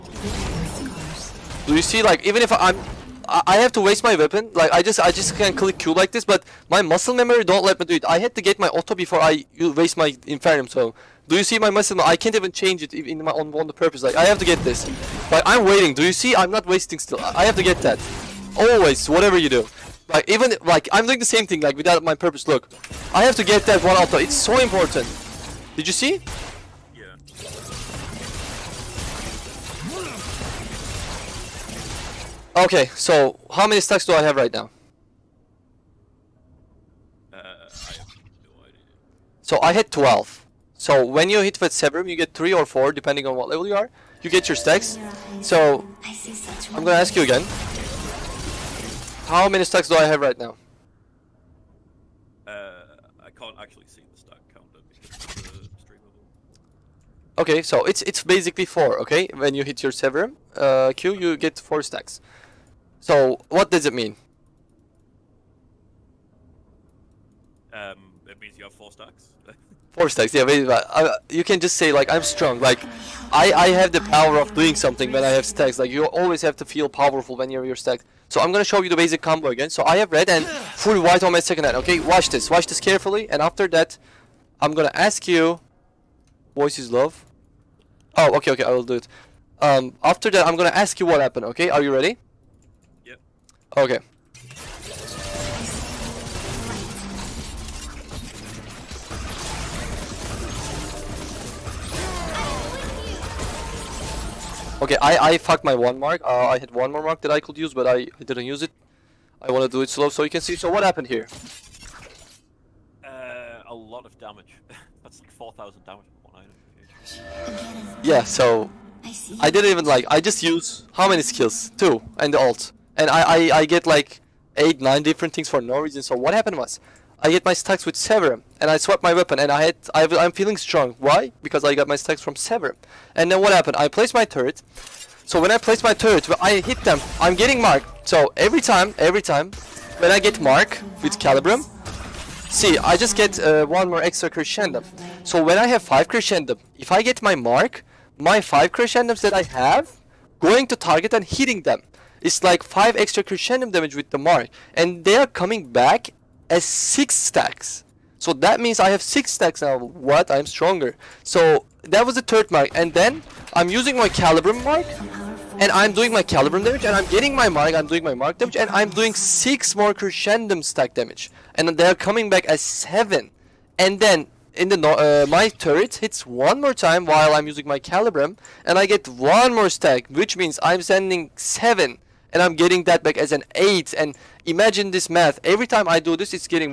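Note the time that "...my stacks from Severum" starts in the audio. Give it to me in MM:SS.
02:11.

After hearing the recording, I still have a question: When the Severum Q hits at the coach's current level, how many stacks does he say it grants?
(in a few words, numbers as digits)
4.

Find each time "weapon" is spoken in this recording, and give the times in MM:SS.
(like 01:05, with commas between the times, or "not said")
00:04, 02:09.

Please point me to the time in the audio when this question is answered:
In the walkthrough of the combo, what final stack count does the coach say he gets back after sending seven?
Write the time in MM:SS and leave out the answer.
03:03.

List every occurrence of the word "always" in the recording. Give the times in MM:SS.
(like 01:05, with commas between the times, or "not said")
00:18, 01:16.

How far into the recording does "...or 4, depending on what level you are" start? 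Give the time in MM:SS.
00:42.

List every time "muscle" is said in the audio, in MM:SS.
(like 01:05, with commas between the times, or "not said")
00:06, 00:11.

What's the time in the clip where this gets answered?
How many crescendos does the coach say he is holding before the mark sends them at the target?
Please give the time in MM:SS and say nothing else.
02:25.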